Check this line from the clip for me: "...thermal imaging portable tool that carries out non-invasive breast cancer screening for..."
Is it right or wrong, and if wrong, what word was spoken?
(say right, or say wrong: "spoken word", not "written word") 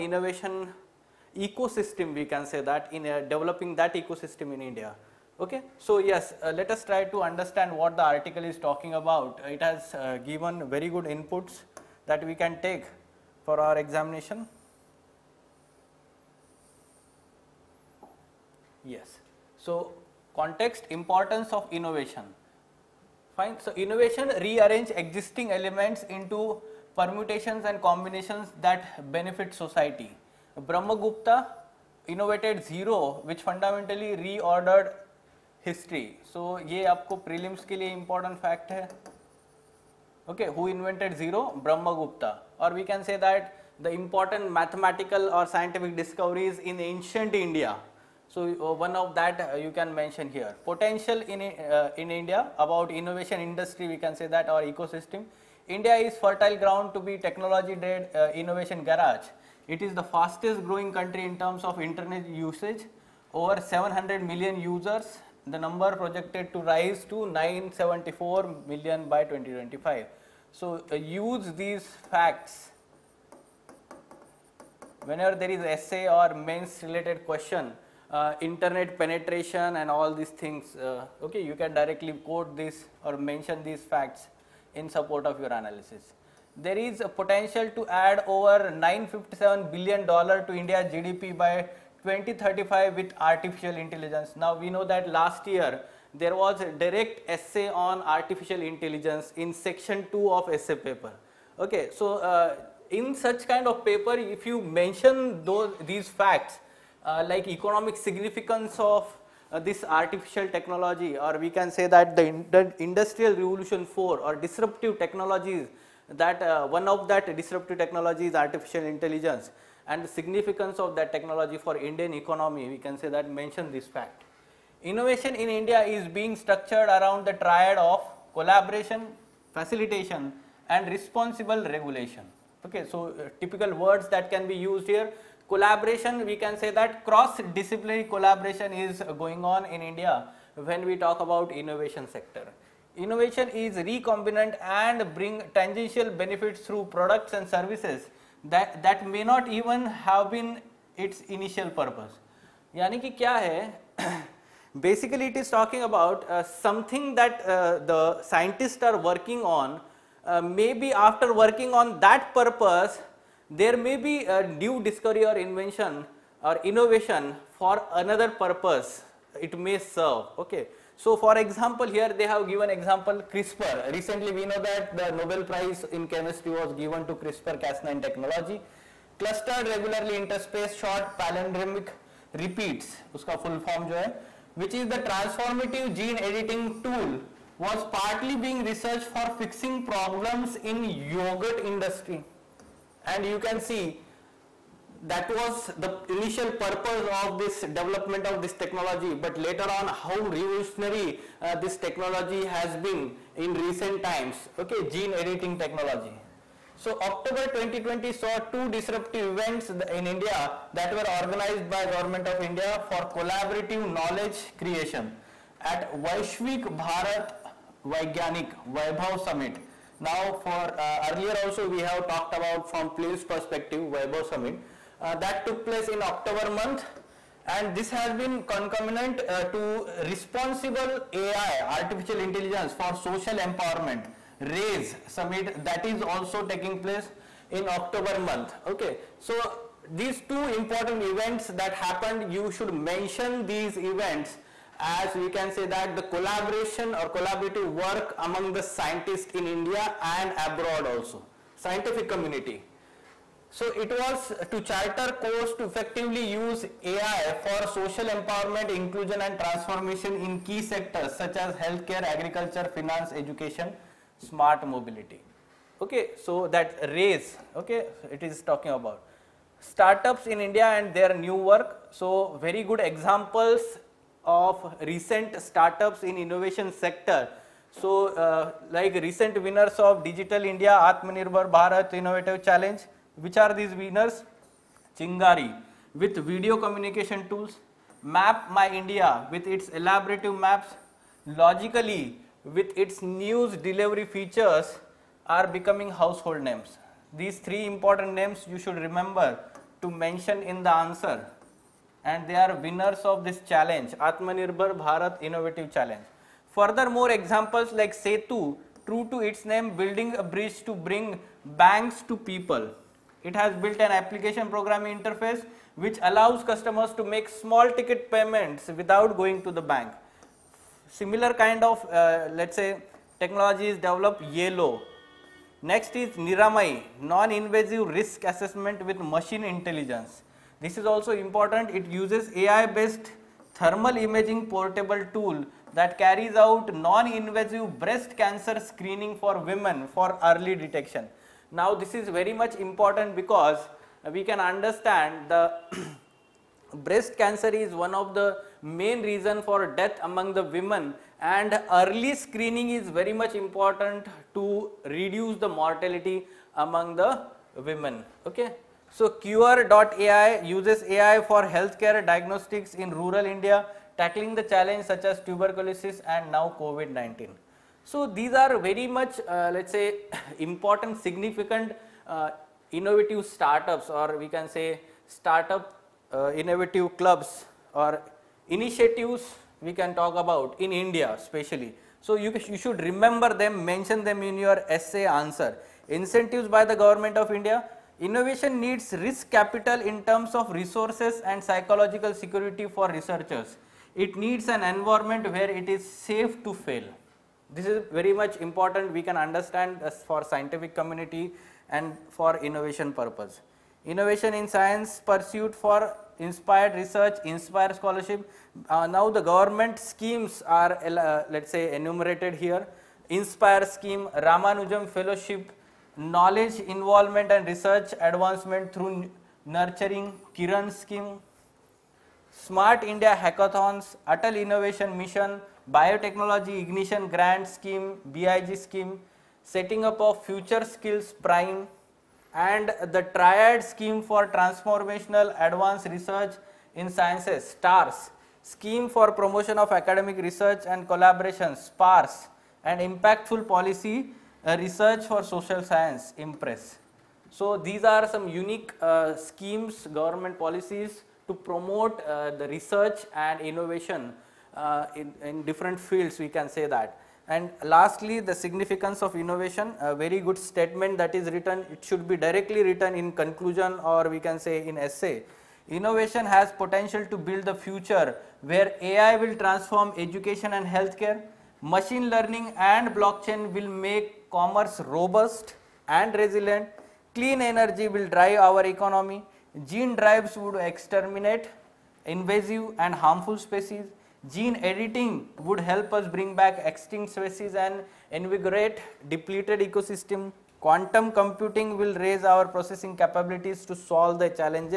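right.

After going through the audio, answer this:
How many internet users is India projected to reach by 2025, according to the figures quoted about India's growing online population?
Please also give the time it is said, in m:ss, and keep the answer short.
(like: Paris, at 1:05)
974 million, at 1:07.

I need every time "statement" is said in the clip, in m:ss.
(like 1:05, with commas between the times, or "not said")
7:40.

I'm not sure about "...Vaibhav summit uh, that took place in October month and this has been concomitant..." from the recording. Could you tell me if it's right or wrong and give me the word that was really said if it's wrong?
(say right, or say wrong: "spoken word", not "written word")
right.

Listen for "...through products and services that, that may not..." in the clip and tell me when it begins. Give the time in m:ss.
2:26.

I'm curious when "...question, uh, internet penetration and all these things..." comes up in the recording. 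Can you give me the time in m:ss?
1:17.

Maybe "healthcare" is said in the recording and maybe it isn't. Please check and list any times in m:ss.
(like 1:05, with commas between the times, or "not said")
4:21, 6:01, 7:50.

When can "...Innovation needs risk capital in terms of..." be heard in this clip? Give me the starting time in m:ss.
6:28.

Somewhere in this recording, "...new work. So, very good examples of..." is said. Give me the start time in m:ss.
4:31.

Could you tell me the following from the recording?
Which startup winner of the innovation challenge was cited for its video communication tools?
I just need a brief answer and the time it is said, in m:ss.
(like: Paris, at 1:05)
Chingari, at 4:44.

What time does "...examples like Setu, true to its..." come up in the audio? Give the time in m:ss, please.
5:07.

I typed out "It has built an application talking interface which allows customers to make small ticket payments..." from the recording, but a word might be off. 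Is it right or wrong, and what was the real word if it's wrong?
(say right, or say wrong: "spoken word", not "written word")
wrong: "programming", not "talking".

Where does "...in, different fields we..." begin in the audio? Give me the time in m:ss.
7:35.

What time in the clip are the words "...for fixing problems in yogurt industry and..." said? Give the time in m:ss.
3:09.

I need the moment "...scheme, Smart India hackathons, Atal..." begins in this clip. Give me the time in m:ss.
7:00.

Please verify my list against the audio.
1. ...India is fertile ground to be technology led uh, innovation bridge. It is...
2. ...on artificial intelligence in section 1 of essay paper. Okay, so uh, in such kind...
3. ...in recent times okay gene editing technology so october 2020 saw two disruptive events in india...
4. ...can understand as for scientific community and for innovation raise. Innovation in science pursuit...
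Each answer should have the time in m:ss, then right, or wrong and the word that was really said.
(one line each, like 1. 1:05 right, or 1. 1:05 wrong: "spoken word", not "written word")
1. 0:55 wrong: "garage", not "bridge"
2. 1:37 wrong: "2", not "1"
3. 3:23 right
4. 6:39 wrong: "purpose", not "raise".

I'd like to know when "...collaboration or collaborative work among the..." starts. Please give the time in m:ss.
4:06.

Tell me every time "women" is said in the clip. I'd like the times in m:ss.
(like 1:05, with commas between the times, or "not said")
5:39, 5:50, 5:57.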